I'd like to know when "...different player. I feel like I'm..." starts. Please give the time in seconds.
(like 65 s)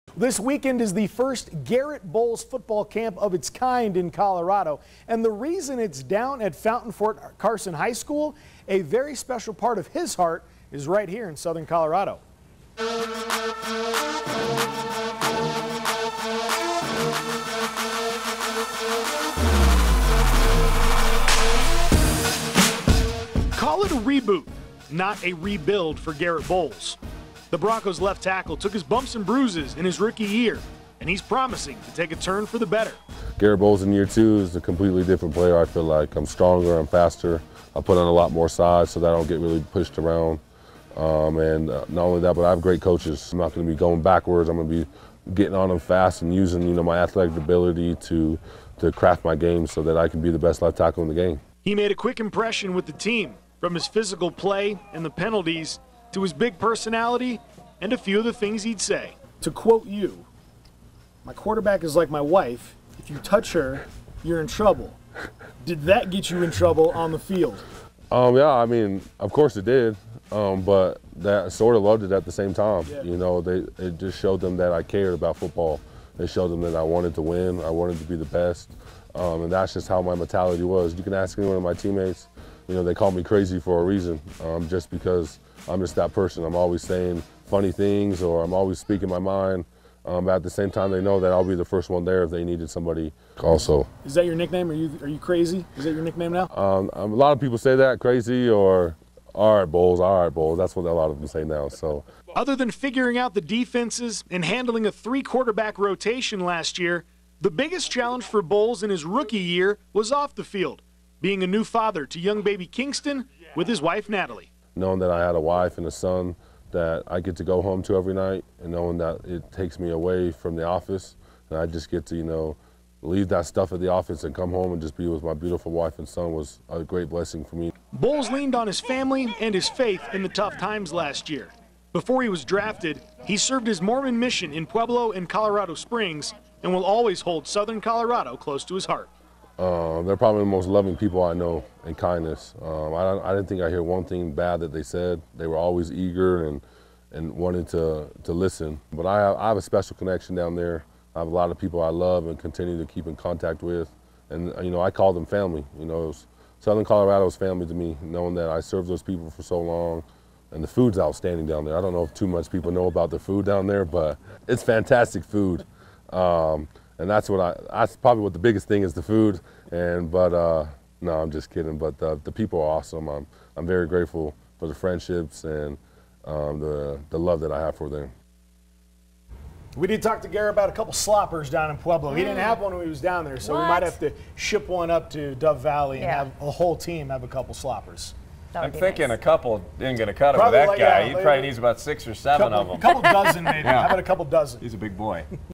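35 s.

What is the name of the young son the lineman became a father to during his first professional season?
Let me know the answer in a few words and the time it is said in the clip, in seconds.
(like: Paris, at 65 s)
Kingston, at 112 s.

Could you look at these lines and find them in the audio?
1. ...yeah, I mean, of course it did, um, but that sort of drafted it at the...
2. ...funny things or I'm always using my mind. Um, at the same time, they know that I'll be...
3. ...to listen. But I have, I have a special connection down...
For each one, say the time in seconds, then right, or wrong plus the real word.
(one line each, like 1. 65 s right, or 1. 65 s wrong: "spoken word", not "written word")
1. 68 s wrong: "loved", not "drafted"
2. 87 s wrong: "speaking", not "using"
3. 148 s right.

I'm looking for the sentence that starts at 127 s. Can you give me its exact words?
Bolles leaned on his family and his faith in the tough times last year.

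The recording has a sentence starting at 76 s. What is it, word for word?
It showed them that I wanted to win, I wanted to be the best, um, and that's just how my mentality was.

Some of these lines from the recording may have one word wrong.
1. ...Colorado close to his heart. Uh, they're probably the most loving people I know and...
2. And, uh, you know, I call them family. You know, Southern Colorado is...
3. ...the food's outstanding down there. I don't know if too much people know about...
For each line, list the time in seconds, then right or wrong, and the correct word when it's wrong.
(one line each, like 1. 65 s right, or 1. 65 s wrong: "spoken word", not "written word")
1. 137 s right
2. 154 s right
3. 160 s right.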